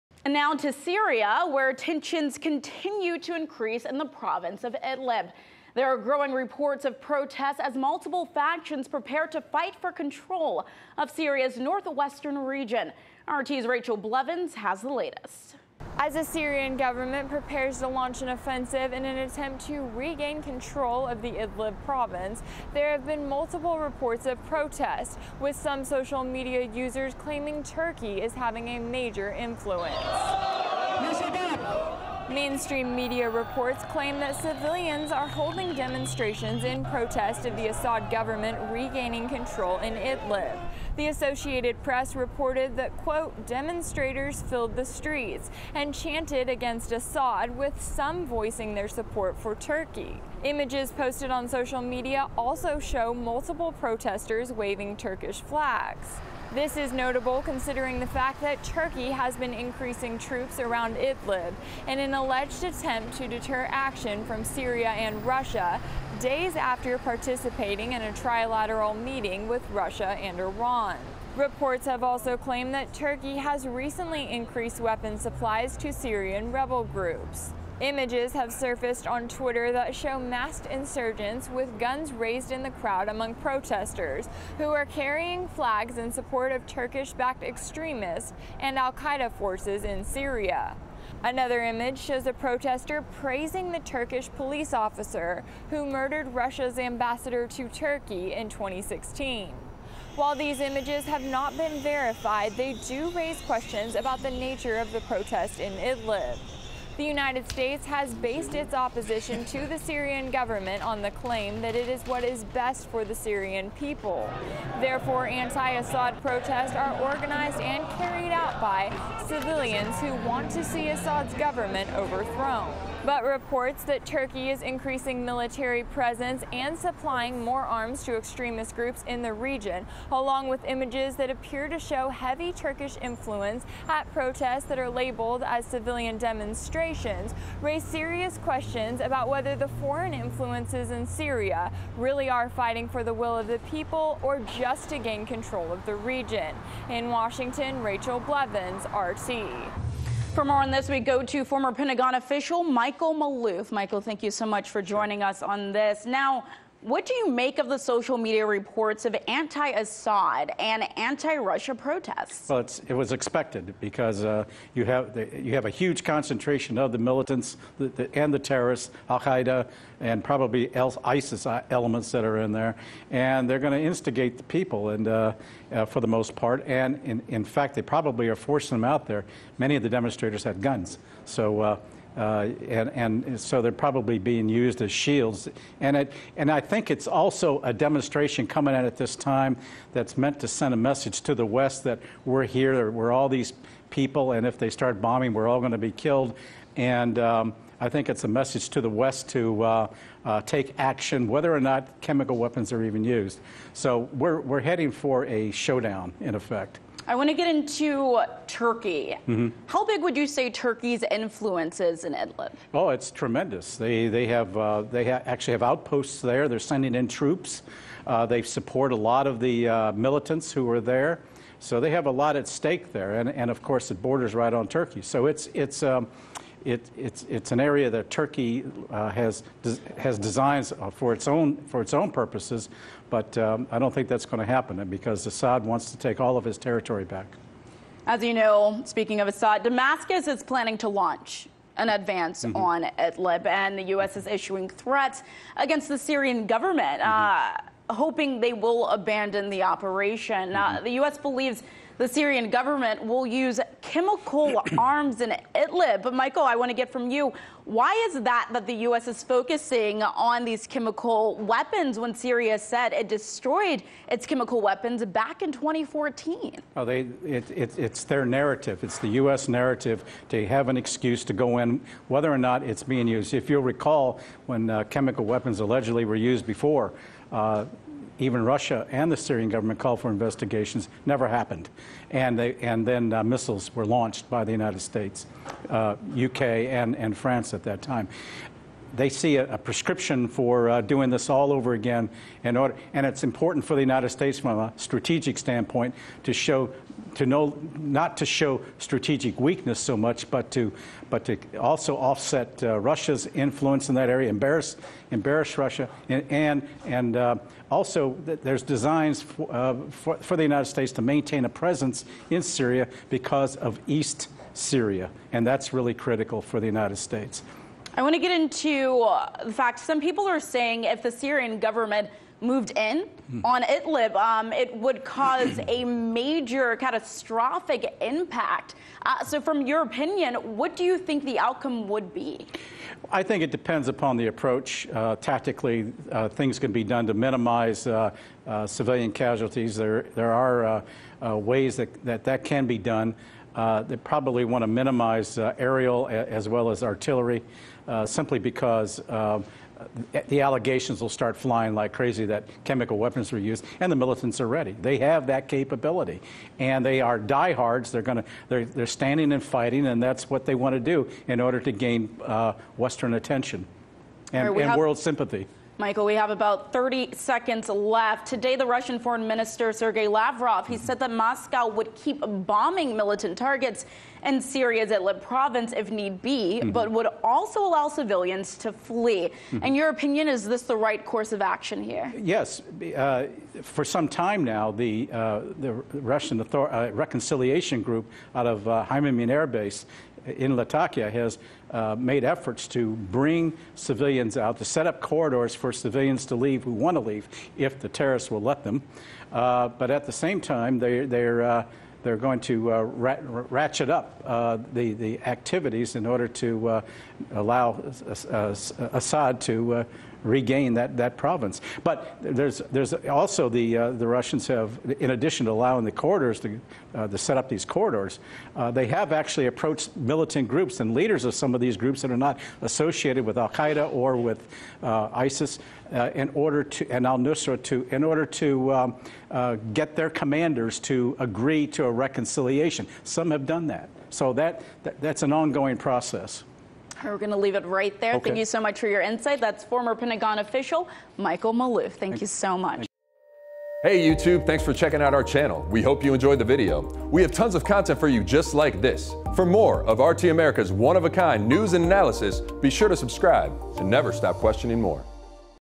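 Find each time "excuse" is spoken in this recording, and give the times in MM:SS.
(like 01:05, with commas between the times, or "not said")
04:30.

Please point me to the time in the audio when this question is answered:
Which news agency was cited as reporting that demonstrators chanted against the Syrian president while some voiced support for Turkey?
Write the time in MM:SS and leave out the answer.
00:40.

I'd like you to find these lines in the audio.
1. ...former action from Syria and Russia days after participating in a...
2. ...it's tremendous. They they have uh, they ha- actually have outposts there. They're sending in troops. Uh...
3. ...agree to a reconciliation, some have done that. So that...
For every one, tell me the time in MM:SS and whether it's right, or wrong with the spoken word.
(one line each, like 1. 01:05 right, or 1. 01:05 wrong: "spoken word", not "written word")
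1. 01:03 wrong: "deter", not "former"
2. 03:32 right
3. 07:11 right.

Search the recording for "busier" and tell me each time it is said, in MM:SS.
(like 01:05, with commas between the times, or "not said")
not said.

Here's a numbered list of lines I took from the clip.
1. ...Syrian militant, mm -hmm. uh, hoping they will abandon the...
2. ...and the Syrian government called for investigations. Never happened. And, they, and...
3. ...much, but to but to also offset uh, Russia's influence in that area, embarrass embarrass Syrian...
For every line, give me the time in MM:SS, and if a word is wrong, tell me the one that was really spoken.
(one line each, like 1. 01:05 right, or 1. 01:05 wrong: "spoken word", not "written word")
1. 04:05 wrong: "government", not "militant"
2. 04:38 right
3. 04:59 wrong: "Russia", not "Syrian".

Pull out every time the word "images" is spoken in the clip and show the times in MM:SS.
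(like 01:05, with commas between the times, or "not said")
00:50, 01:17, 01:31, 01:40, 02:10.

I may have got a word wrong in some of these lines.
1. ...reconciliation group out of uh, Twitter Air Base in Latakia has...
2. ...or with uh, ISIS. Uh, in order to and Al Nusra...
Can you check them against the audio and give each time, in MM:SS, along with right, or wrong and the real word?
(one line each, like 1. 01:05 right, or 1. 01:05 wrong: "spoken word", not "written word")
1. 06:27 wrong: "Hmeimim", not "Twitter"
2. 07:03 right.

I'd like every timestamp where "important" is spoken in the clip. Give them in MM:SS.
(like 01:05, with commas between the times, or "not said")
04:53.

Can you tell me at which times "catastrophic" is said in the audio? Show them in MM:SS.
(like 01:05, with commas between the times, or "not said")
05:26.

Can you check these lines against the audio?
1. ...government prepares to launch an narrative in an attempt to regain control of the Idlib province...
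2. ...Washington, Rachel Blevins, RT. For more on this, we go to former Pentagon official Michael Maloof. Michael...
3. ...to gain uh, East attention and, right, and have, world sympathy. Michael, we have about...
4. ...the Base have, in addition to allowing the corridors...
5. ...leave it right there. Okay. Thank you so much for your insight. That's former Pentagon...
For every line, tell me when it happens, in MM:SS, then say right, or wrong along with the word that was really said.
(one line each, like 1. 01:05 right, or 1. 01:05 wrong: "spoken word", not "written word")
1. 00:16 wrong: "offensive", not "narrative"
2. 02:27 right
3. 06:01 wrong: "Western", not "East"
4. 06:53 wrong: "Russians", not "Base"
5. 07:17 right.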